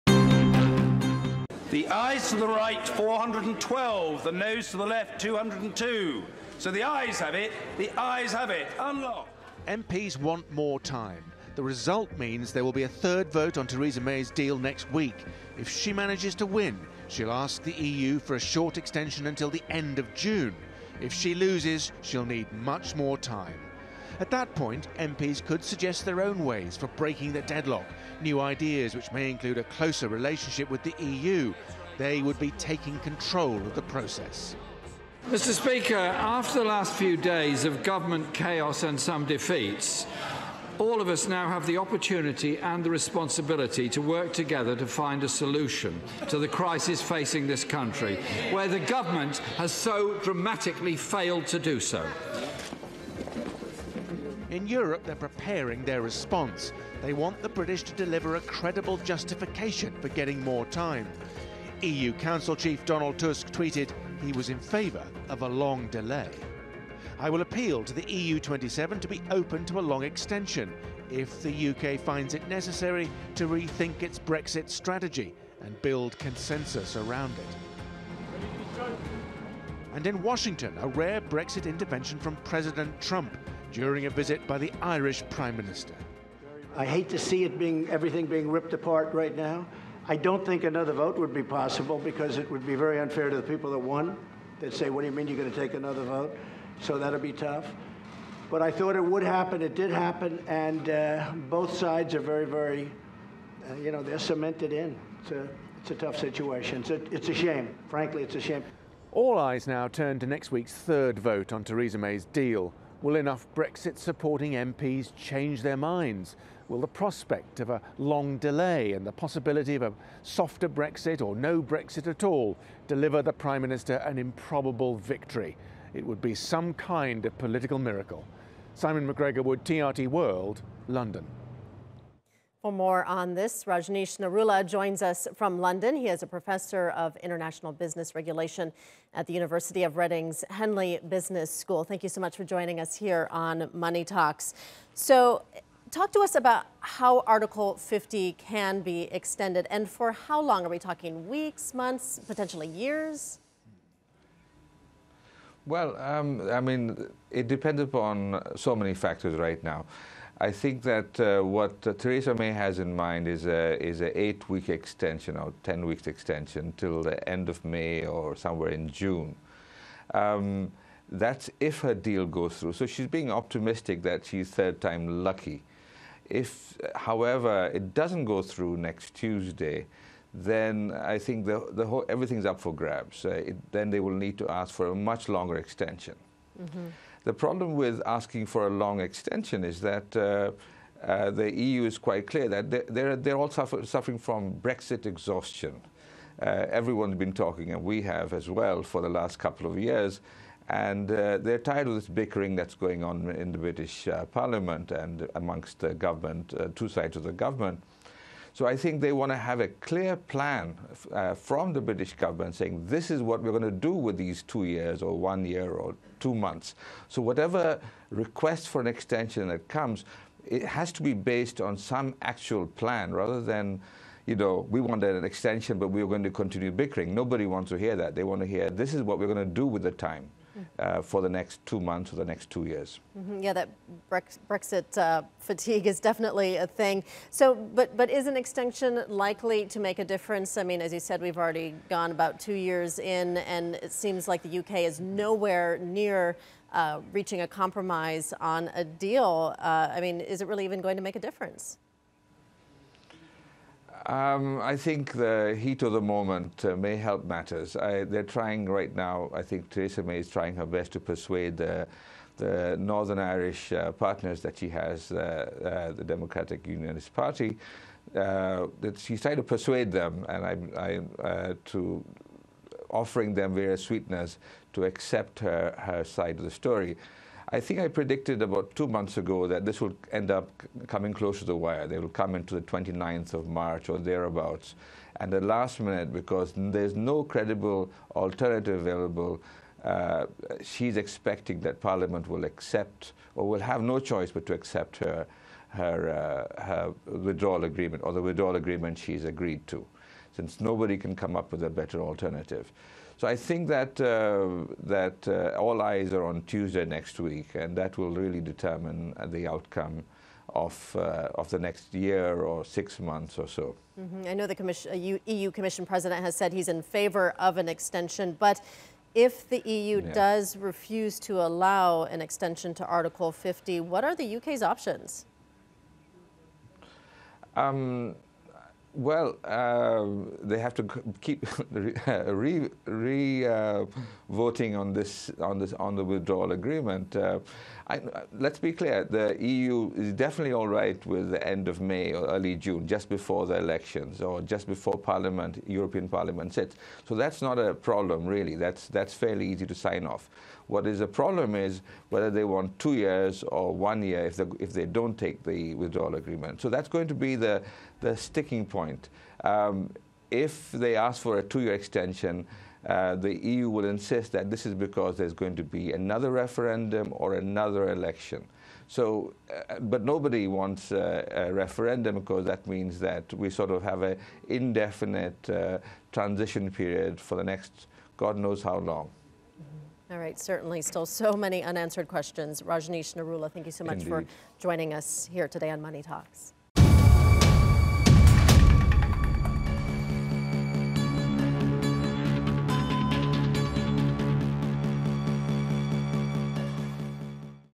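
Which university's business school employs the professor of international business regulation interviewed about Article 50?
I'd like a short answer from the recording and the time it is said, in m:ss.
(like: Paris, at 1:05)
University of Reading, at 2:19.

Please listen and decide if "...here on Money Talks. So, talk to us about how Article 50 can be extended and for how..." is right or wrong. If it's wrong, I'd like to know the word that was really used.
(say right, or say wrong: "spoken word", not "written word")
right.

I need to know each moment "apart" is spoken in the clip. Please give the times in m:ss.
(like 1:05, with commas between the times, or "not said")
1:28.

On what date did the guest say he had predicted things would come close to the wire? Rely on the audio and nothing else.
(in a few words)
29th of March.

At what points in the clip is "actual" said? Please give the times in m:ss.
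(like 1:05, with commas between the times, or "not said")
3:42.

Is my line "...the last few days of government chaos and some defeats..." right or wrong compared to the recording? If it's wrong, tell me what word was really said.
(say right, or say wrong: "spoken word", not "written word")
right.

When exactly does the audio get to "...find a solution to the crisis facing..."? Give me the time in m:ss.
0:44.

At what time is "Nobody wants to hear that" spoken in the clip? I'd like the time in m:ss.
3:47.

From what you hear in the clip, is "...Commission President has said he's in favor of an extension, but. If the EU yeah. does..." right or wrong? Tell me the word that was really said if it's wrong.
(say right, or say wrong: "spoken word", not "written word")
right.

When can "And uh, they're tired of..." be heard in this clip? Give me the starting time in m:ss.
3:20.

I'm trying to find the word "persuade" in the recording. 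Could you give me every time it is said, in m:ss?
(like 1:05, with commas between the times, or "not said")
4:20, 4:29.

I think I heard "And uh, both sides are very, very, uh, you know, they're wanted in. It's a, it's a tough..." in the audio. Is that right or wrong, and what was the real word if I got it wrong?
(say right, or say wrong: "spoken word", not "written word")
wrong: "cemented", not "wanted".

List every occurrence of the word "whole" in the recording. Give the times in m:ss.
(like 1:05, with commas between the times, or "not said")
3:01.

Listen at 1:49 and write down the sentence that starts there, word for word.
All eyes now turn to next week's third vote on Theresa May's deal Will enough Brexit supporting MPs change their minds?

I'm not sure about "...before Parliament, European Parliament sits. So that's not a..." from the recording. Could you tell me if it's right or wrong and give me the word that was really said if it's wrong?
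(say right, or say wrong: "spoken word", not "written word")
right.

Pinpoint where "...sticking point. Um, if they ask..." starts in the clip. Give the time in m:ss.
5:58.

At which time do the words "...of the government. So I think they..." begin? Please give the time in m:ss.
3:27.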